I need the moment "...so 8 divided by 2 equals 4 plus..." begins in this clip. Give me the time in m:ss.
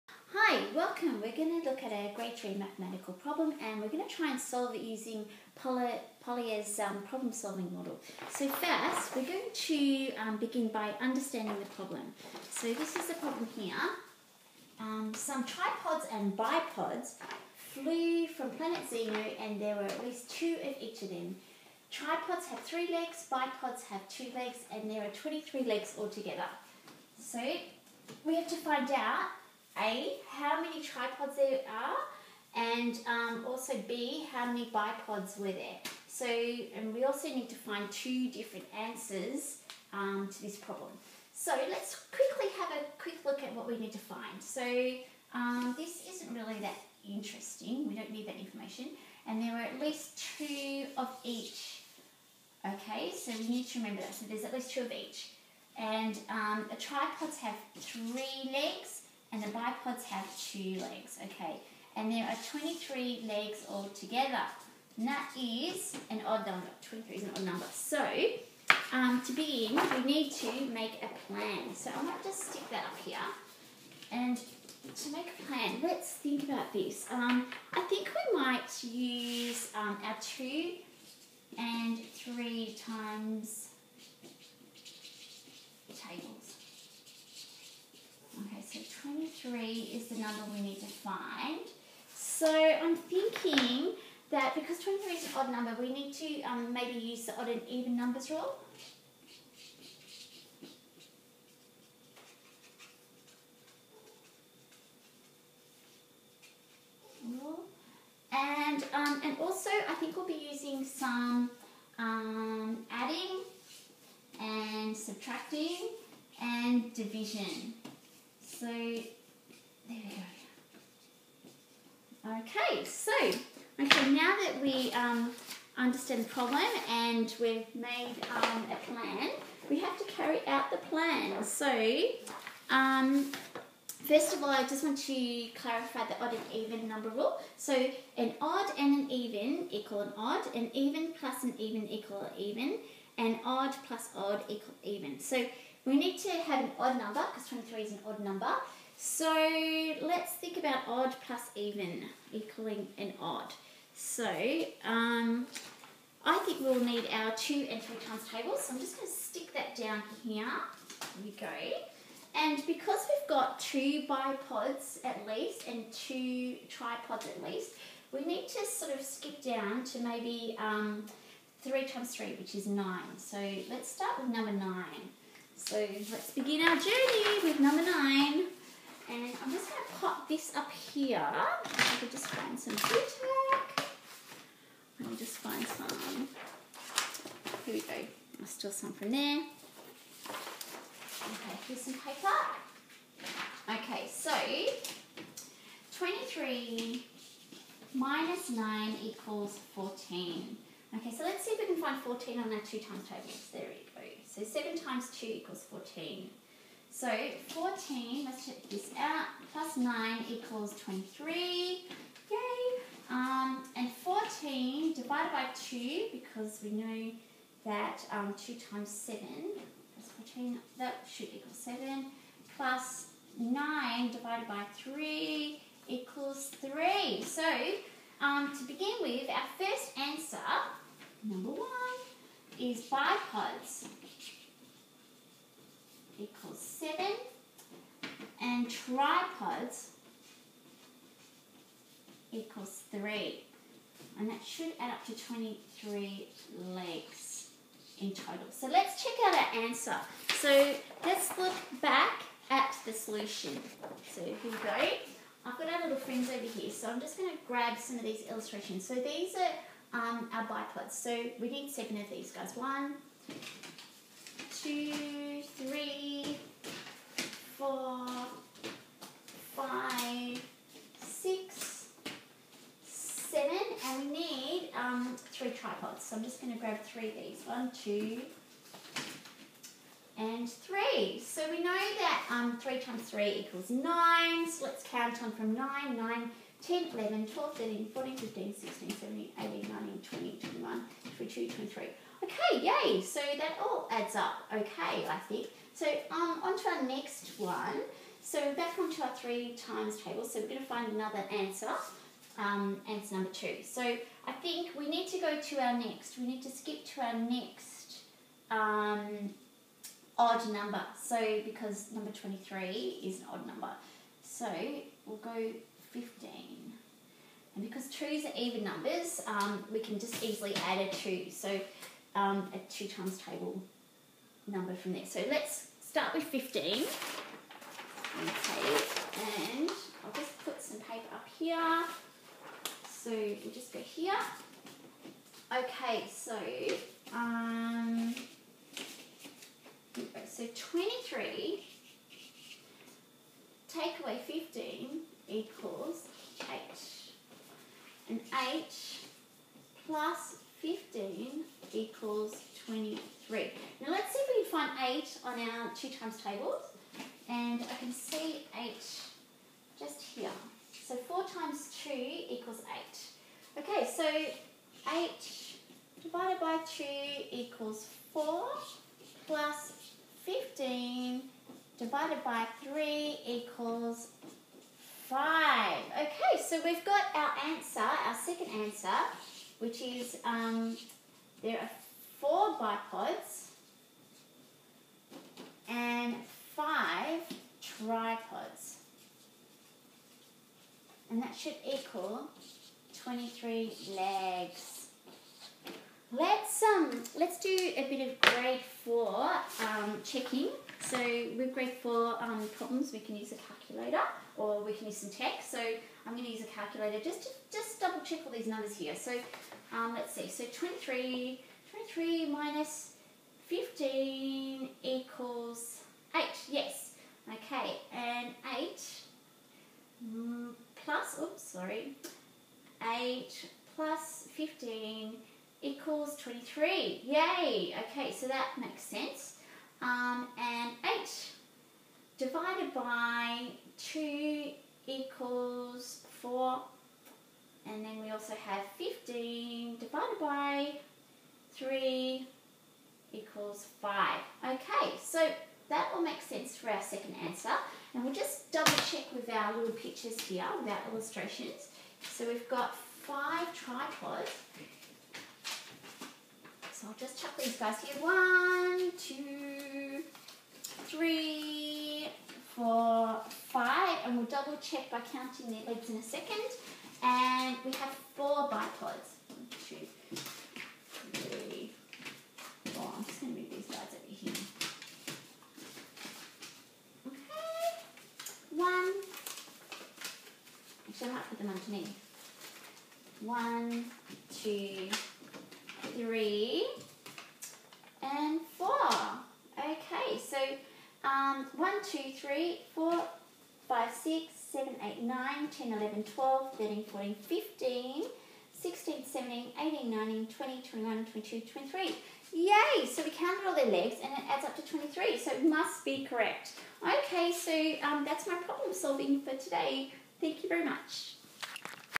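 6:03.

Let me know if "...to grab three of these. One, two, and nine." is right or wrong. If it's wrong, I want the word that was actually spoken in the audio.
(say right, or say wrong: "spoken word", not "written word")
wrong: "three", not "nine".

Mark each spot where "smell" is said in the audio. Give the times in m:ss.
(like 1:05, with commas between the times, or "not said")
not said.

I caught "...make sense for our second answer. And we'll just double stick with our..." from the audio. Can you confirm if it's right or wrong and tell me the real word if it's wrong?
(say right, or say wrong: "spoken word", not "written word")
wrong: "check", not "stick".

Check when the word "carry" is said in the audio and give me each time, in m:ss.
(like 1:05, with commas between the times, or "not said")
2:10.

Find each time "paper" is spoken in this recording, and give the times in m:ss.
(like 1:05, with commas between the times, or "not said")
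3:11, 5:30.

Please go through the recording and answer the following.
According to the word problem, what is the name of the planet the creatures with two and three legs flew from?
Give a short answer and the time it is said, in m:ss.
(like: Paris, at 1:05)
Xenu, at 0:18.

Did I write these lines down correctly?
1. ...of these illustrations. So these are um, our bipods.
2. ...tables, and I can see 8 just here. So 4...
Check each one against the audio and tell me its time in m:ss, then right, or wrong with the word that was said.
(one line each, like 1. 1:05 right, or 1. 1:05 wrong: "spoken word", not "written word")
1. 4:17 right
2. 5:56 right.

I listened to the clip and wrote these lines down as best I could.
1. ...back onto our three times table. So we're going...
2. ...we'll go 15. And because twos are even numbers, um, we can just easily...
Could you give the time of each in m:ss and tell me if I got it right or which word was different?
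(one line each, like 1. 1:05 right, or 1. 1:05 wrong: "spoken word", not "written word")
1. 4:58 right
2. 5:15 right.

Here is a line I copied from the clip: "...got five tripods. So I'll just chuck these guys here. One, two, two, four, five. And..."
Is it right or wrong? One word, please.
wrong.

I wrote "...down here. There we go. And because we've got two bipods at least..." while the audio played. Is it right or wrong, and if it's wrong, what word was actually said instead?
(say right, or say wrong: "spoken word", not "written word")
right.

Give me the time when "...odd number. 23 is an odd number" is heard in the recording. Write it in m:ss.
1:06.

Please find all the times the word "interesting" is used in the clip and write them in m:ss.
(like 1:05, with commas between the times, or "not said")
0:47.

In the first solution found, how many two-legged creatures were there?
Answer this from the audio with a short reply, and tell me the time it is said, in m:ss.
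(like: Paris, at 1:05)
7, at 3:52.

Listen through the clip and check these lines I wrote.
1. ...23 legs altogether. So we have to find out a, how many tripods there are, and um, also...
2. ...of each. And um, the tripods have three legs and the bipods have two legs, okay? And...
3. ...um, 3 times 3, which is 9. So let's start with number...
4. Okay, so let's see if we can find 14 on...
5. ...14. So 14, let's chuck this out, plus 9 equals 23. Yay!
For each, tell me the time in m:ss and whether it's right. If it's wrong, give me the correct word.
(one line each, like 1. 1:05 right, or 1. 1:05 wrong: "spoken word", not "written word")
1. 0:25 right
2. 0:54 right
3. 2:50 right
4. 3:20 right
5. 3:25 wrong: "check", not "chuck".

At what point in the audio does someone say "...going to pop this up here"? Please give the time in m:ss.
2:59.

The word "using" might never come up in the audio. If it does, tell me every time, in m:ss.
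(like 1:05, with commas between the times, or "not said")
0:04, 1:50.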